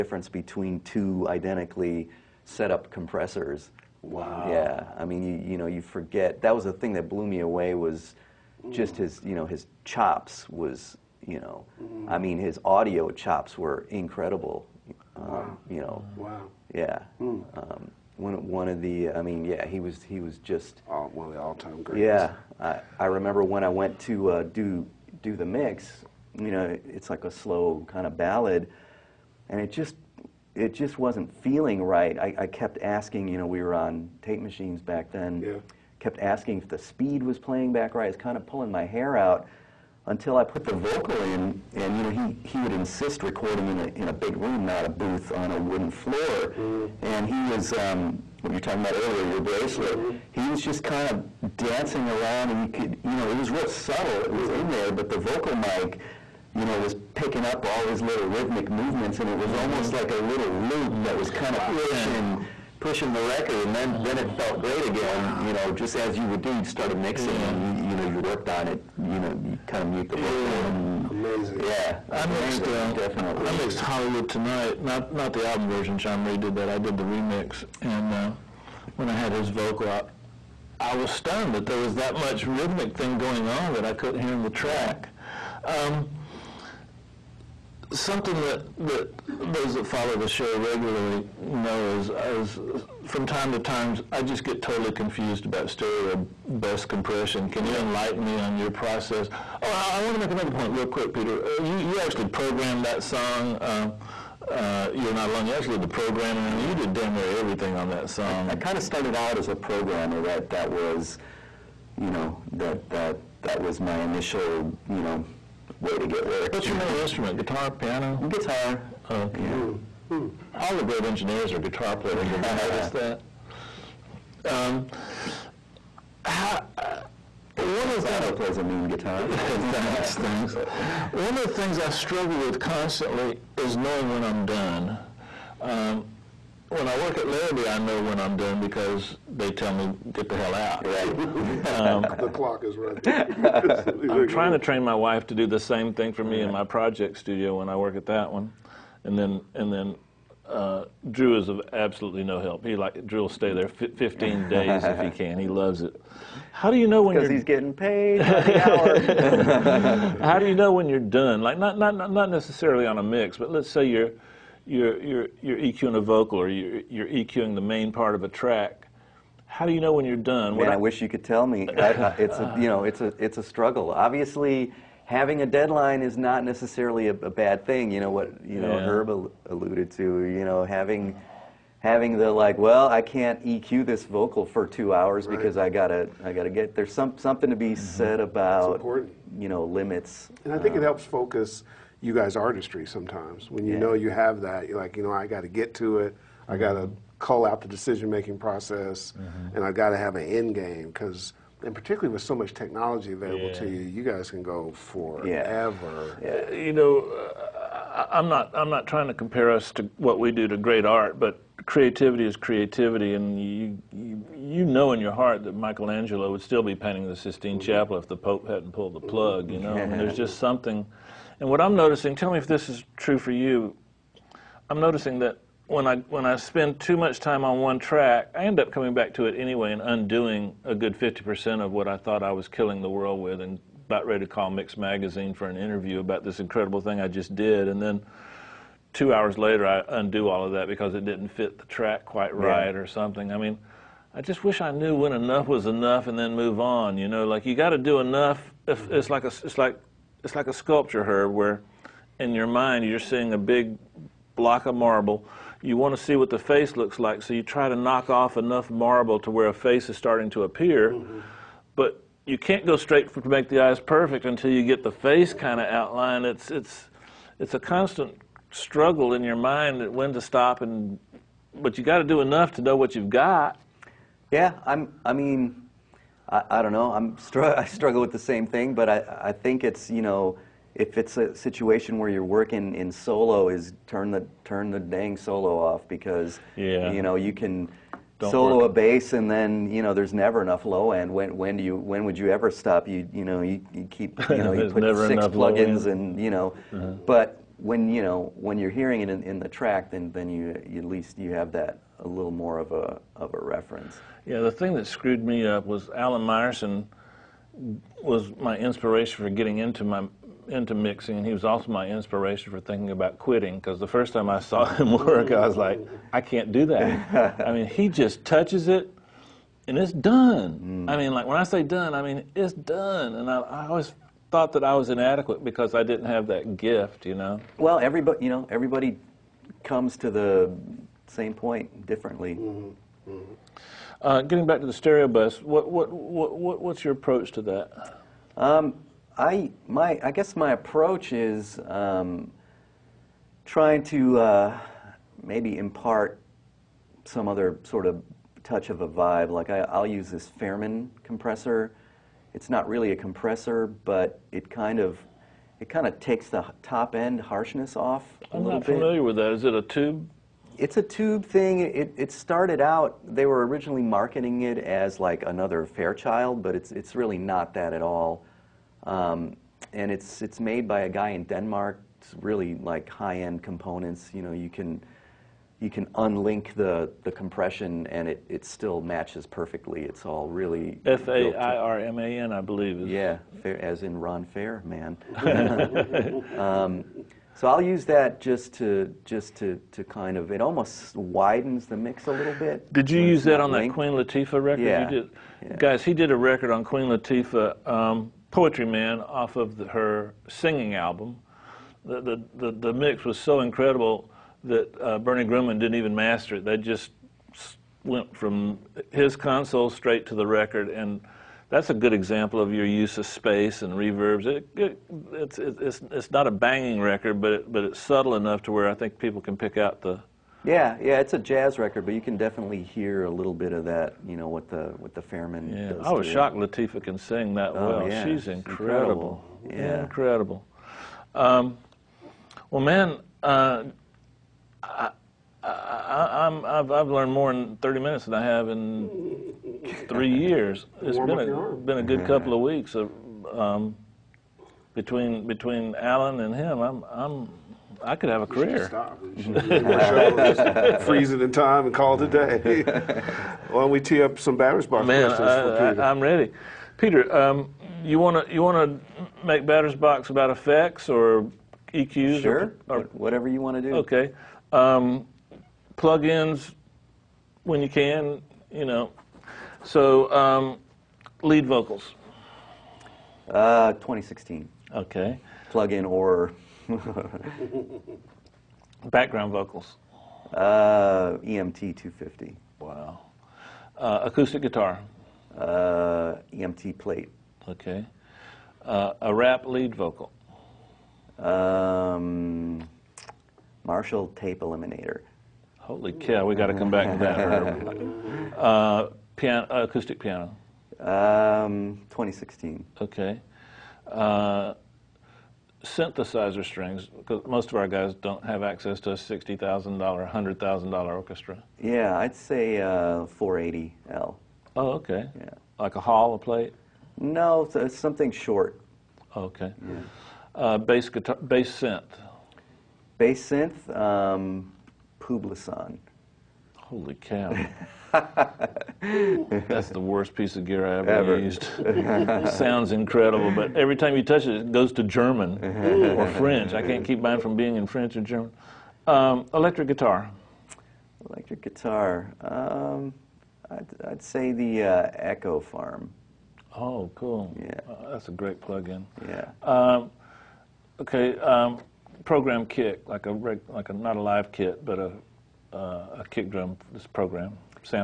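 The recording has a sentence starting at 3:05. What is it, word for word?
because I gotta I gotta get there's some something to be mm-hmm.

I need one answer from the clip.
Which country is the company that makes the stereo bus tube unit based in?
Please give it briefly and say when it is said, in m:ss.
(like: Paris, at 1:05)
Denmark, at 6:11.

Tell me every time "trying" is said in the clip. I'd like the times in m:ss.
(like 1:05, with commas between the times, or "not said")
2:24, 3:28, 5:43.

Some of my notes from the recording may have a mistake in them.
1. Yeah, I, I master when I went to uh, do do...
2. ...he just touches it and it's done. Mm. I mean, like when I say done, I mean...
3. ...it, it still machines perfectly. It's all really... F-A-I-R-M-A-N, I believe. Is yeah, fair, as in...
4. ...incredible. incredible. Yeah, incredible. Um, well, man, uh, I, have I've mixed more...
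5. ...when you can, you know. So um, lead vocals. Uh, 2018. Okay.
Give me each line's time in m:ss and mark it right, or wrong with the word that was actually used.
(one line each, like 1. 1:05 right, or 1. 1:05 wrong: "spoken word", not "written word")
1. 0:22 wrong: "remember", not "master"
2. 5:17 right
3. 6:18 wrong: "matches", not "machines"
4. 7:08 wrong: "learned", not "mixed"
5. 7:47 wrong: "2016", not "2018".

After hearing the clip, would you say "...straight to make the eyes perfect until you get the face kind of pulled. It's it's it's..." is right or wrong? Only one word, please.
wrong.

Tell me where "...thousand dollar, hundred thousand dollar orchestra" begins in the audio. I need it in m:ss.
8:29.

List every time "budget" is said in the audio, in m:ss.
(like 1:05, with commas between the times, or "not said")
not said.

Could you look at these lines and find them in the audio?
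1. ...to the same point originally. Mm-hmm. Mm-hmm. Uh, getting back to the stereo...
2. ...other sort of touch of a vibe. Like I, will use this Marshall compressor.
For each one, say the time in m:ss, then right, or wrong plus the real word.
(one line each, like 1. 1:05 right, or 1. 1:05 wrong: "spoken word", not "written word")
1. 5:29 wrong: "differently", not "originally"
2. 5:47 wrong: "Fairman", not "Marshall".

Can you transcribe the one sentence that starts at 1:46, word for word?
you did damn near everything on that song.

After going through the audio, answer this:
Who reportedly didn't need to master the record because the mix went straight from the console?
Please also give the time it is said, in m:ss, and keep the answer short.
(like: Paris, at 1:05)
Bernie Grundman, at 6:44.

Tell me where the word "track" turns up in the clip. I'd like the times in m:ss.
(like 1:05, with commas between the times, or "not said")
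1:24, 2:48, 3:47, 4:01, 4:59.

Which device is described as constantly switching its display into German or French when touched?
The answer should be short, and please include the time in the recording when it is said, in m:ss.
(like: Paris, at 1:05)
Publison, at 8:44.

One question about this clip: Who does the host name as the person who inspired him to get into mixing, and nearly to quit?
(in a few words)
Alan Meyerson.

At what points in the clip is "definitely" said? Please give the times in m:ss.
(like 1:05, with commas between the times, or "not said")
1:12, 7:02.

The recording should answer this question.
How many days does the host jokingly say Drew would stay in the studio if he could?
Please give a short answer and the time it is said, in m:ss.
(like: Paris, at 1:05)
15, at 2:33.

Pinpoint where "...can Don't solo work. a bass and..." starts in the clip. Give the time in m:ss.
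4:47.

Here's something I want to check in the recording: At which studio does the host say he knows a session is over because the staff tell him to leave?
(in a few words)
Larrabee.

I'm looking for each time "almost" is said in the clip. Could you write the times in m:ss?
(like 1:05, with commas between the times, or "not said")
0:59, 6:30.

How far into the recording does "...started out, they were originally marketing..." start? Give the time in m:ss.
6:02.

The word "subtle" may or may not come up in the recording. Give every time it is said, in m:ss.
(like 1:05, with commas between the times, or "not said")
0:53, 6:57.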